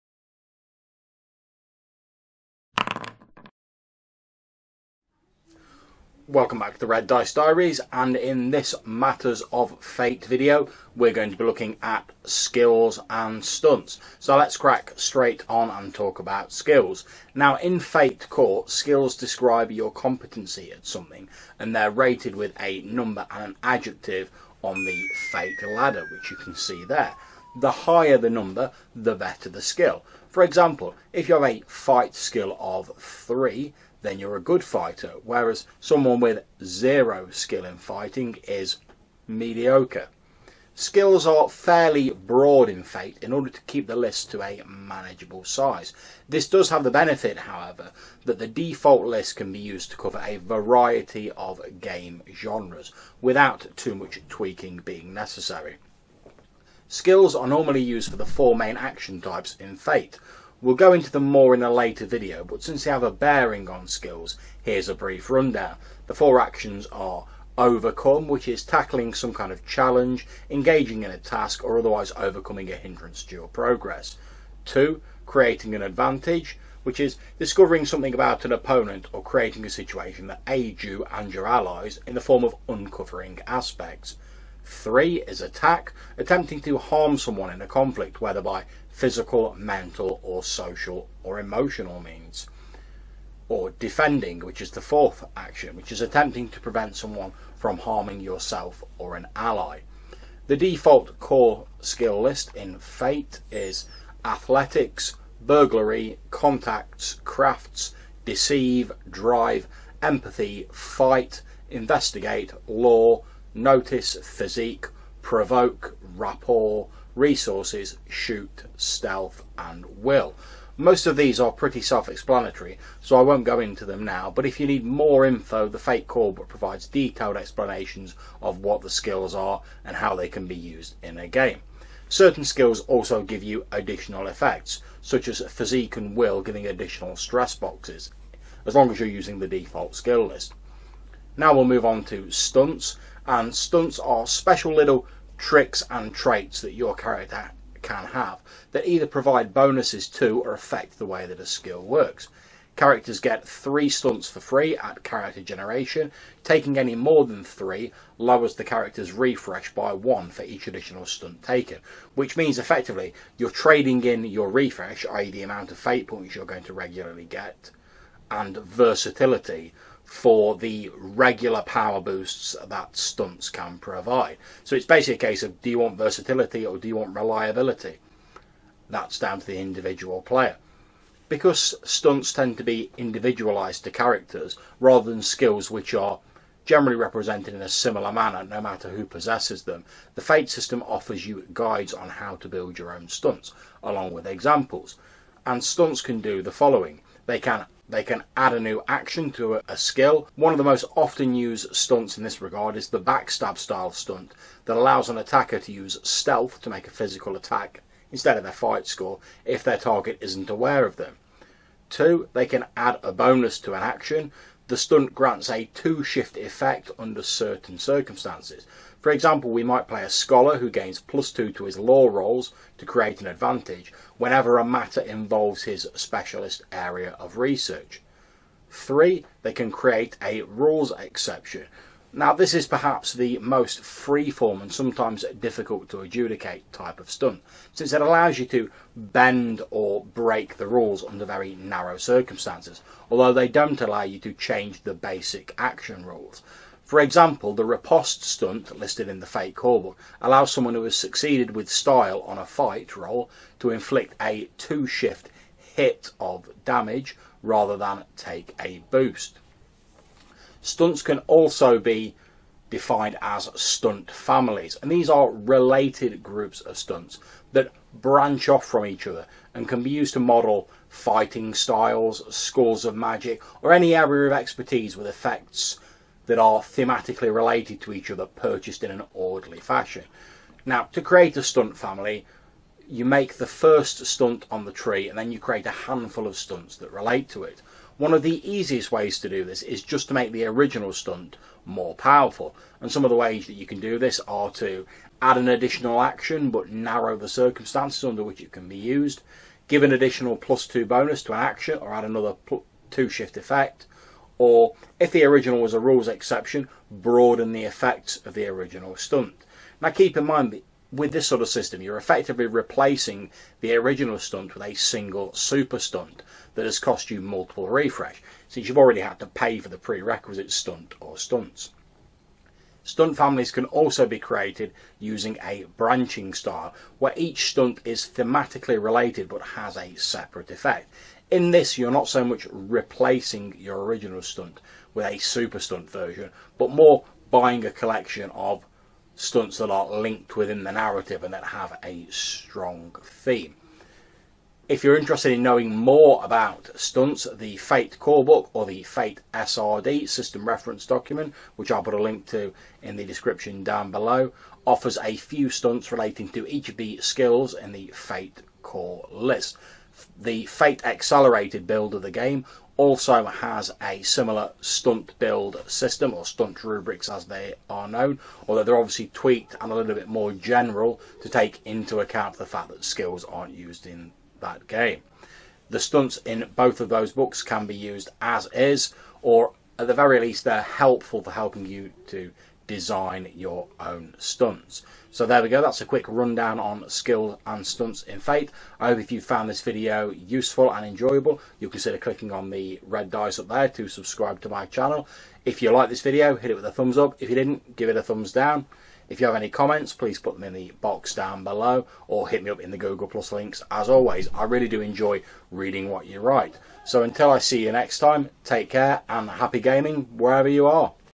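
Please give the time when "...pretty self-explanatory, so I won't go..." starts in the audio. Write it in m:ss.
2:01.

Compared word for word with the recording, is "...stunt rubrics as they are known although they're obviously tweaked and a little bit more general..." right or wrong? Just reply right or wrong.
right.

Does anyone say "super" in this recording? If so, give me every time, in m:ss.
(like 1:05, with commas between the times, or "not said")
5:15, 5:35.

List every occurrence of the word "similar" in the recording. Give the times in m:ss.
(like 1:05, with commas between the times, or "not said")
3:07, 6:04.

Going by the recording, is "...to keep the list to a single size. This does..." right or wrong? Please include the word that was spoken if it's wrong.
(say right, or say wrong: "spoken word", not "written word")
wrong: "manageable", not "single".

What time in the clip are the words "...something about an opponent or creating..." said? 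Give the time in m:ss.
1:17.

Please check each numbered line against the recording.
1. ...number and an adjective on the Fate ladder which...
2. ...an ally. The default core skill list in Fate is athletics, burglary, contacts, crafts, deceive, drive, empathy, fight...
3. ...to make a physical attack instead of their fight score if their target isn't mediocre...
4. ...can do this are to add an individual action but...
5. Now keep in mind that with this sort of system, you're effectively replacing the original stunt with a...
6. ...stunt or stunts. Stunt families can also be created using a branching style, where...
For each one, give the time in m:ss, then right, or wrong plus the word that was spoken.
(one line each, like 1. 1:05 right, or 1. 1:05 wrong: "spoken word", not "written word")
1. 0:22 right
2. 1:39 right
3. 3:26 wrong: "aware", not "mediocre"
4. 4:53 wrong: "additional", not "individual"
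5. 5:09 right
6. 5:20 right.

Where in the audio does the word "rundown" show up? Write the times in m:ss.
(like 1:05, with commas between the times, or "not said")
1:05, 6:26.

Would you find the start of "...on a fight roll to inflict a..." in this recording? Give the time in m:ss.
4:12.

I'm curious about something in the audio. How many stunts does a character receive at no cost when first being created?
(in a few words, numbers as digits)
3.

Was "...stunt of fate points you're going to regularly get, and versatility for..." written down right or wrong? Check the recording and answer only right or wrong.
wrong.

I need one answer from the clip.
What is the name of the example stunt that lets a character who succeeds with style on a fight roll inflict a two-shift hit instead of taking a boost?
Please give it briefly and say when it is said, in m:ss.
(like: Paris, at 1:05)
Riposte, at 4:07.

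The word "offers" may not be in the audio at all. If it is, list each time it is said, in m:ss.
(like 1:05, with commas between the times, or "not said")
3:10, 5:54.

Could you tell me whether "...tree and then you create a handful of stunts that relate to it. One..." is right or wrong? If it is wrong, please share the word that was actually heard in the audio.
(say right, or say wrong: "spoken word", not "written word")
right.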